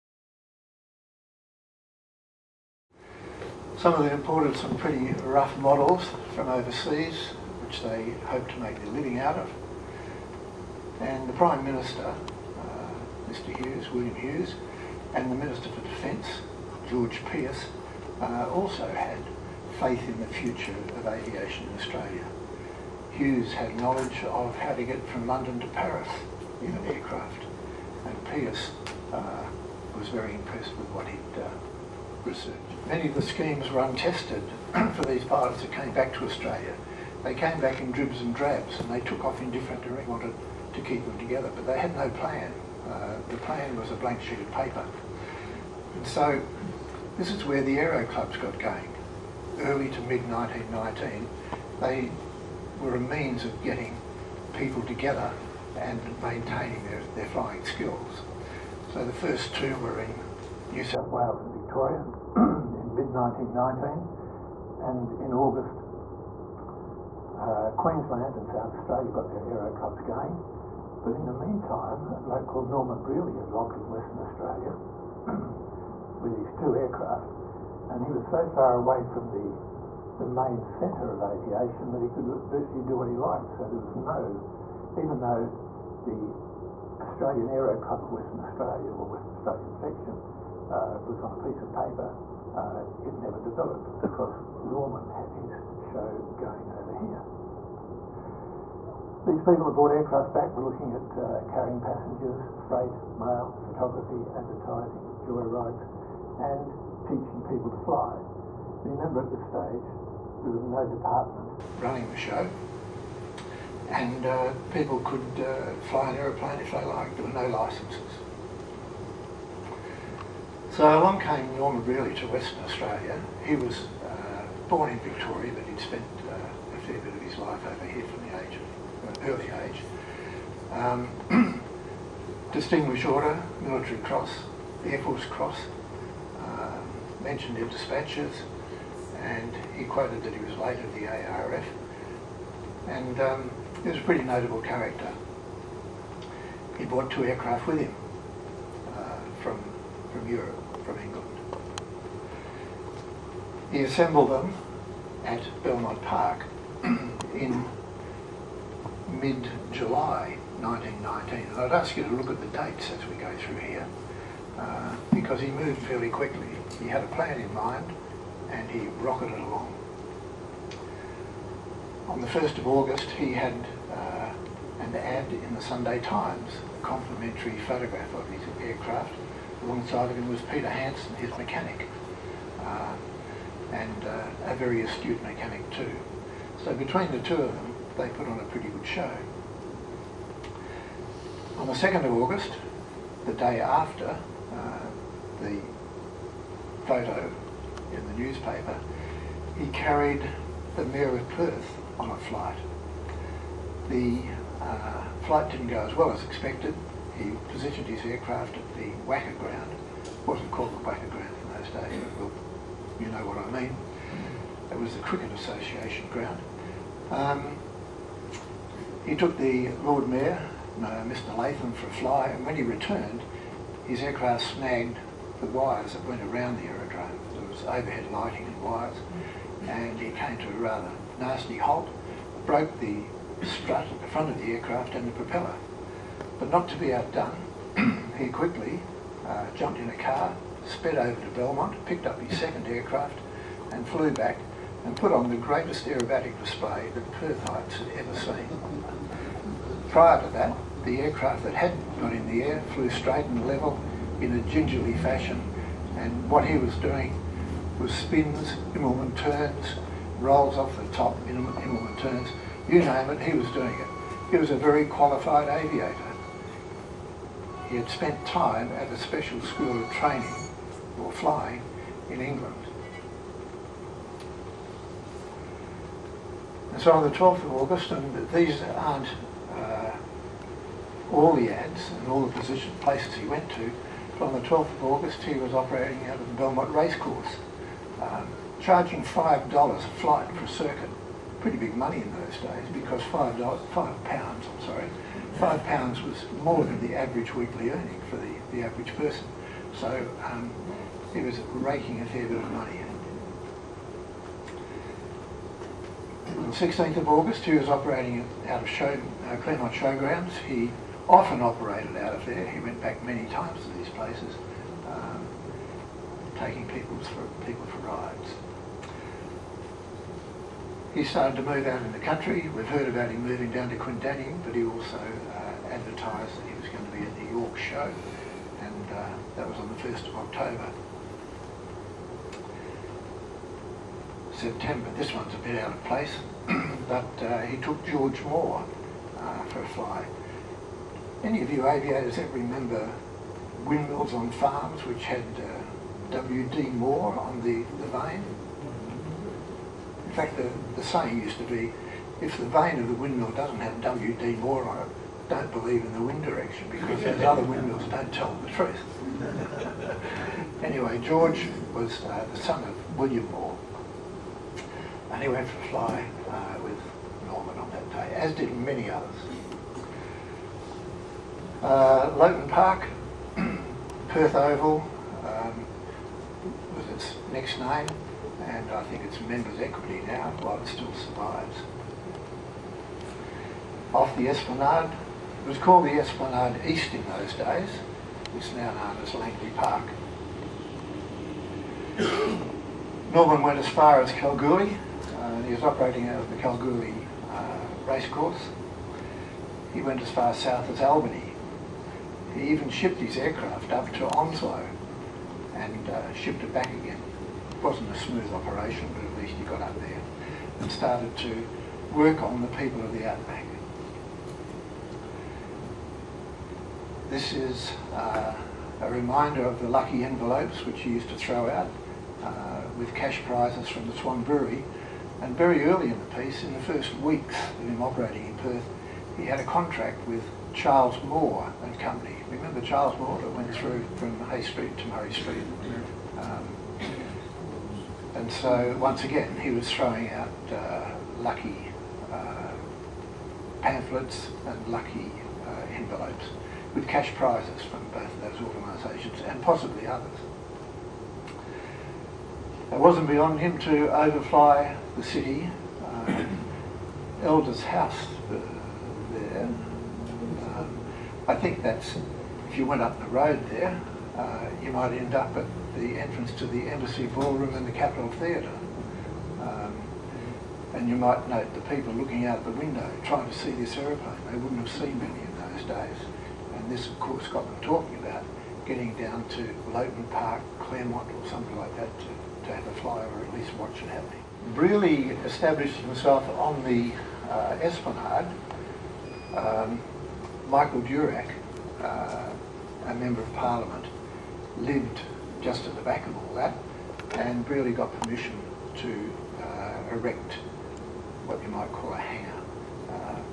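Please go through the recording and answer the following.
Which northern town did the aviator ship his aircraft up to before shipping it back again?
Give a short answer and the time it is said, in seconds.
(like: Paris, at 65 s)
Onslow, at 404 s.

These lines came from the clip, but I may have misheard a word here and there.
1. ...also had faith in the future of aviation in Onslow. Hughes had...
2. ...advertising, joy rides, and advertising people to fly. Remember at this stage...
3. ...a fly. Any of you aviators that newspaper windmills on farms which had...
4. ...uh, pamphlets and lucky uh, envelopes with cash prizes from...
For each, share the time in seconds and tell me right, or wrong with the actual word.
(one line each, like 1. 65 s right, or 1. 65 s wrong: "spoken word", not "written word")
1. 18 s wrong: "Australia", not "Onslow"
2. 104 s wrong: "teaching", not "advertising"
3. 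339 s wrong: "remember", not "newspaper"
4. 442 s right.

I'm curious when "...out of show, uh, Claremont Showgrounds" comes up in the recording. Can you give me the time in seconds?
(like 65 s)
308 s.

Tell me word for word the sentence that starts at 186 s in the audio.
So between the two of them, they put on a pretty good show.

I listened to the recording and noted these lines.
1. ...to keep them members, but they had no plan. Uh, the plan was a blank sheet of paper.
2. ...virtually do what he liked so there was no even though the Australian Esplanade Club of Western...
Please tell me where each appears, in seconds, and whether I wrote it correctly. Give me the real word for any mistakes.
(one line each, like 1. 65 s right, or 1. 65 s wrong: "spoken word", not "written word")
1. 40 s wrong: "together", not "members"
2. 82 s wrong: "Aero", not "Esplanade".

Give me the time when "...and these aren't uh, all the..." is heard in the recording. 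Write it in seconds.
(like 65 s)
277 s.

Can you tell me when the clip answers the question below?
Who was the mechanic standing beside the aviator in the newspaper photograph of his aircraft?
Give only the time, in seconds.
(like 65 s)
180 s.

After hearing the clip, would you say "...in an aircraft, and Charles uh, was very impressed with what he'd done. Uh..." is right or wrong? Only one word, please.
wrong.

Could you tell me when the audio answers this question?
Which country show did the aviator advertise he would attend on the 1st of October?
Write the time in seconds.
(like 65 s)
327 s.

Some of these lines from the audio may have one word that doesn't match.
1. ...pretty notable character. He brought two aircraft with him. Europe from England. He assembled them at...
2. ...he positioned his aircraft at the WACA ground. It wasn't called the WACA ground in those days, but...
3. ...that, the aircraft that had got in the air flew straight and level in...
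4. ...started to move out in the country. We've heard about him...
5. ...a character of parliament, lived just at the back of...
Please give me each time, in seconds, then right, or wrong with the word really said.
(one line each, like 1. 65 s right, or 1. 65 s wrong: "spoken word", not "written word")
1. 144 s right
2. 207 s right
3. 250 s right
4. 321 s right
5. 492 s wrong: "member", not "character".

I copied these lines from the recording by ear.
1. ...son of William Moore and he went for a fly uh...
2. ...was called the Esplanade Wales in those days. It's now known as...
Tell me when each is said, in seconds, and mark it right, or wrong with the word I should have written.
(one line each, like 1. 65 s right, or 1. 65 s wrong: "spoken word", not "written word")
1. 362 s right
2. 385 s wrong: "East", not "Wales".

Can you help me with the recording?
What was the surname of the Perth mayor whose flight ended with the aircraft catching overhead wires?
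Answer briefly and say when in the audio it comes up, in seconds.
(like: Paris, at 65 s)
Lathlain, at 221 s.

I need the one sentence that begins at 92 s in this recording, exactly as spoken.
Uh, it never developed because Norman had his show going over here.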